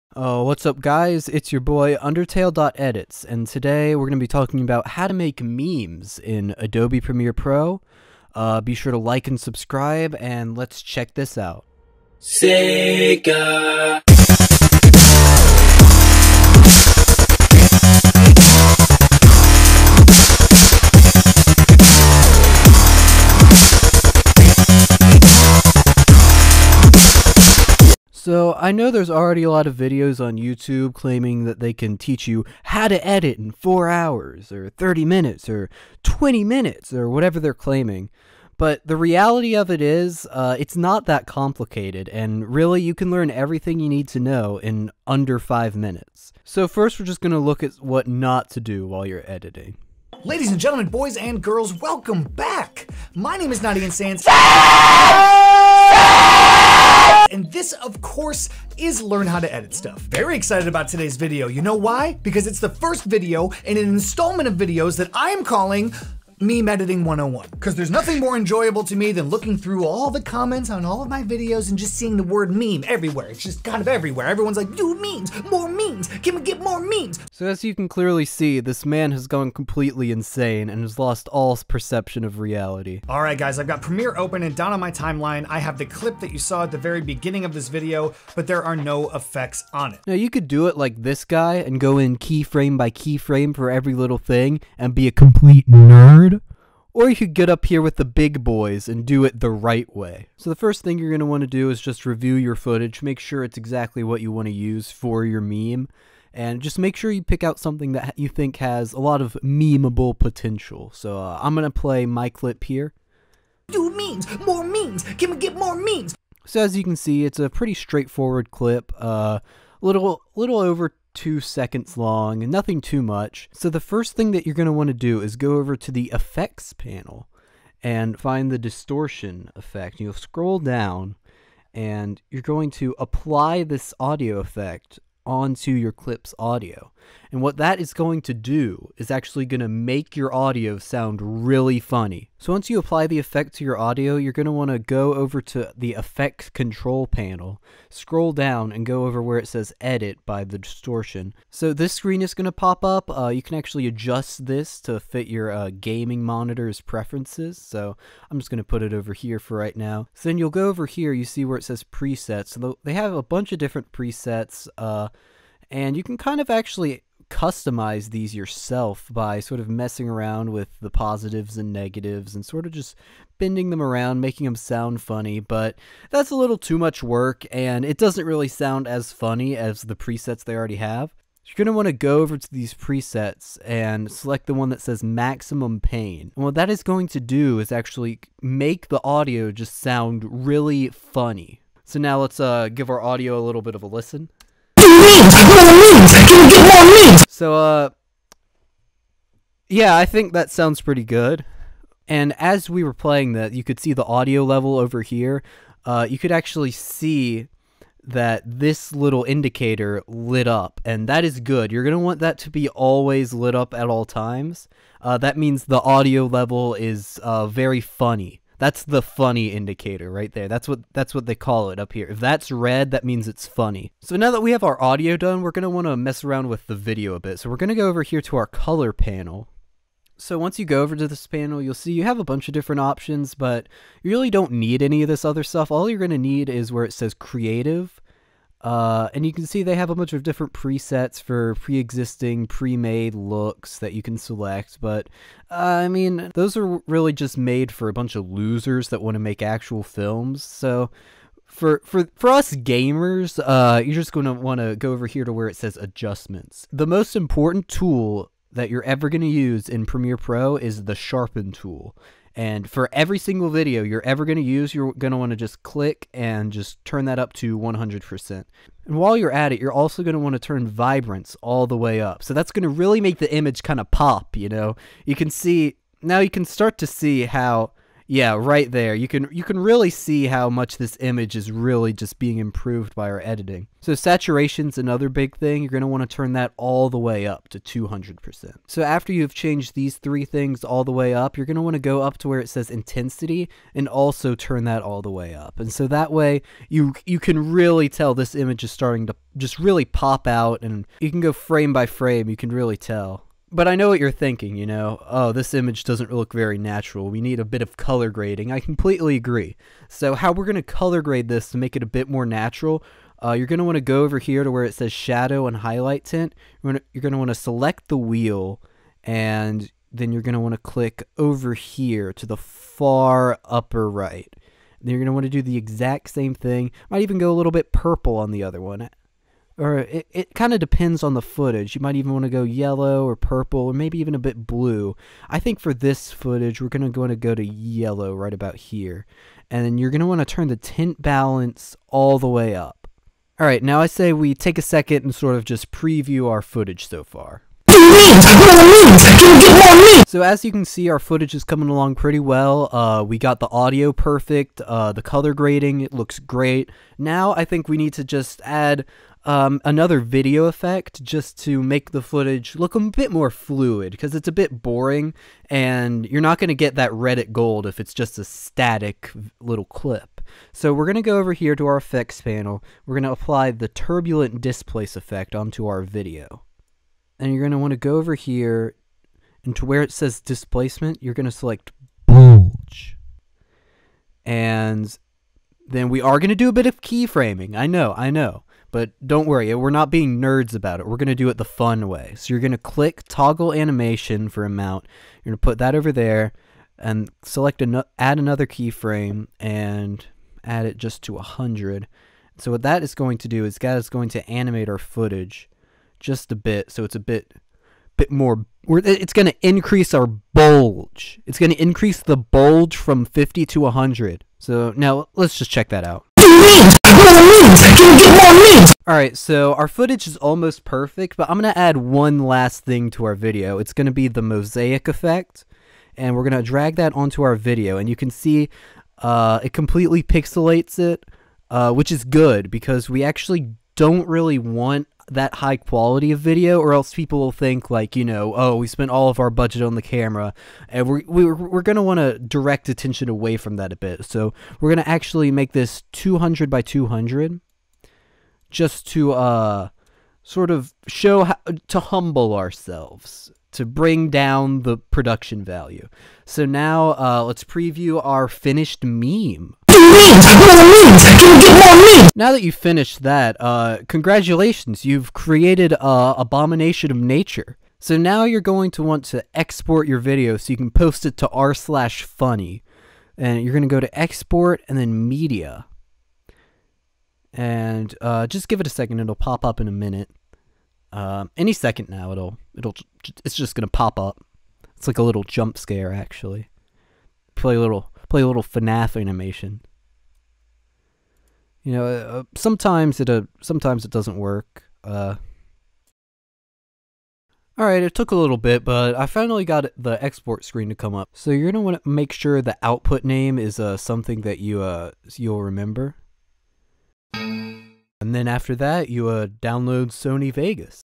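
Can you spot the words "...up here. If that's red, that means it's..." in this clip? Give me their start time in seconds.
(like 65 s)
221 s.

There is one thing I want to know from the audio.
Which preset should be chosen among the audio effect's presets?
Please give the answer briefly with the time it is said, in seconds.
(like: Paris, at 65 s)
maximum pain, at 185 s.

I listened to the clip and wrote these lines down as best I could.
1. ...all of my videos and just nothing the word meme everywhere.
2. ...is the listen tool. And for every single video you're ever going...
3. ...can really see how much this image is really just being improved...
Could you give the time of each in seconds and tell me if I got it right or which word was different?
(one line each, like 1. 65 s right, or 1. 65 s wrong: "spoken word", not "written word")
1. 70 s wrong: "seeing", not "nothing"
2. 260 s wrong: "sharpen", not "listen"
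3. 279 s right.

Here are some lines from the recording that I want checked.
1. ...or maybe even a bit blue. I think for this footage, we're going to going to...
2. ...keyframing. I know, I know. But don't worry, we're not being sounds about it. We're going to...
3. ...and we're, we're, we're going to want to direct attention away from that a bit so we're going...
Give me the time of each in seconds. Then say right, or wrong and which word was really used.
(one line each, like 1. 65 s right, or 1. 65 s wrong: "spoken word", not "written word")
1. 333 s right
2. 386 s wrong: "nerds", not "sounds"
3. 440 s right.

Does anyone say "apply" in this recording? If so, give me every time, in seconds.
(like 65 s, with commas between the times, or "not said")
132 s, 142 s, 373 s.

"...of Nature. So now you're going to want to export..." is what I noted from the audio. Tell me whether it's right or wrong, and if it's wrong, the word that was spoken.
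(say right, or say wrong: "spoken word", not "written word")
right.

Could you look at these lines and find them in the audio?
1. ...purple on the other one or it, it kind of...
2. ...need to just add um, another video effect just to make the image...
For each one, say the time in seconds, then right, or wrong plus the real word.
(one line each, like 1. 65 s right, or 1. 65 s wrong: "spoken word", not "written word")
1. 327 s right
2. 357 s wrong: "footage", not "image".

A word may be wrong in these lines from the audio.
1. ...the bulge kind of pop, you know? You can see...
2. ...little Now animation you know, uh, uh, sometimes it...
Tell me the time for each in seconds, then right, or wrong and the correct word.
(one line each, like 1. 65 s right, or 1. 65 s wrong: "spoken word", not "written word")
1. 273 s wrong: "image", not "bulge"
2. 488 s wrong: "FNAF", not "Now".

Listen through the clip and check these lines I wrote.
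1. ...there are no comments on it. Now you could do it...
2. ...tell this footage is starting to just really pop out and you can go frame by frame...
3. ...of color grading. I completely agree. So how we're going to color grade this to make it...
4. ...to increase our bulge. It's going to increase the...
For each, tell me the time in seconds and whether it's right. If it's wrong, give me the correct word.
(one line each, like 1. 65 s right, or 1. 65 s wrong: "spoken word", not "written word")
1. 88 s wrong: "effects", not "comments"
2. 297 s wrong: "image", not "footage"
3. 307 s right
4. 409 s right.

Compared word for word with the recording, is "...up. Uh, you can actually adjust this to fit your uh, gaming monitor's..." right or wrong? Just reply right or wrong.
right.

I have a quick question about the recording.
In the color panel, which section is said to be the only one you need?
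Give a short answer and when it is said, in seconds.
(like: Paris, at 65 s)
creative, at 237 s.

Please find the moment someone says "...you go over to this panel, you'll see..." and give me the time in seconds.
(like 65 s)
230 s.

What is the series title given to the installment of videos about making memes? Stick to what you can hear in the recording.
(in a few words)
meme editing 101.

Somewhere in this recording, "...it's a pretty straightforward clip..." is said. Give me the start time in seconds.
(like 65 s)
117 s.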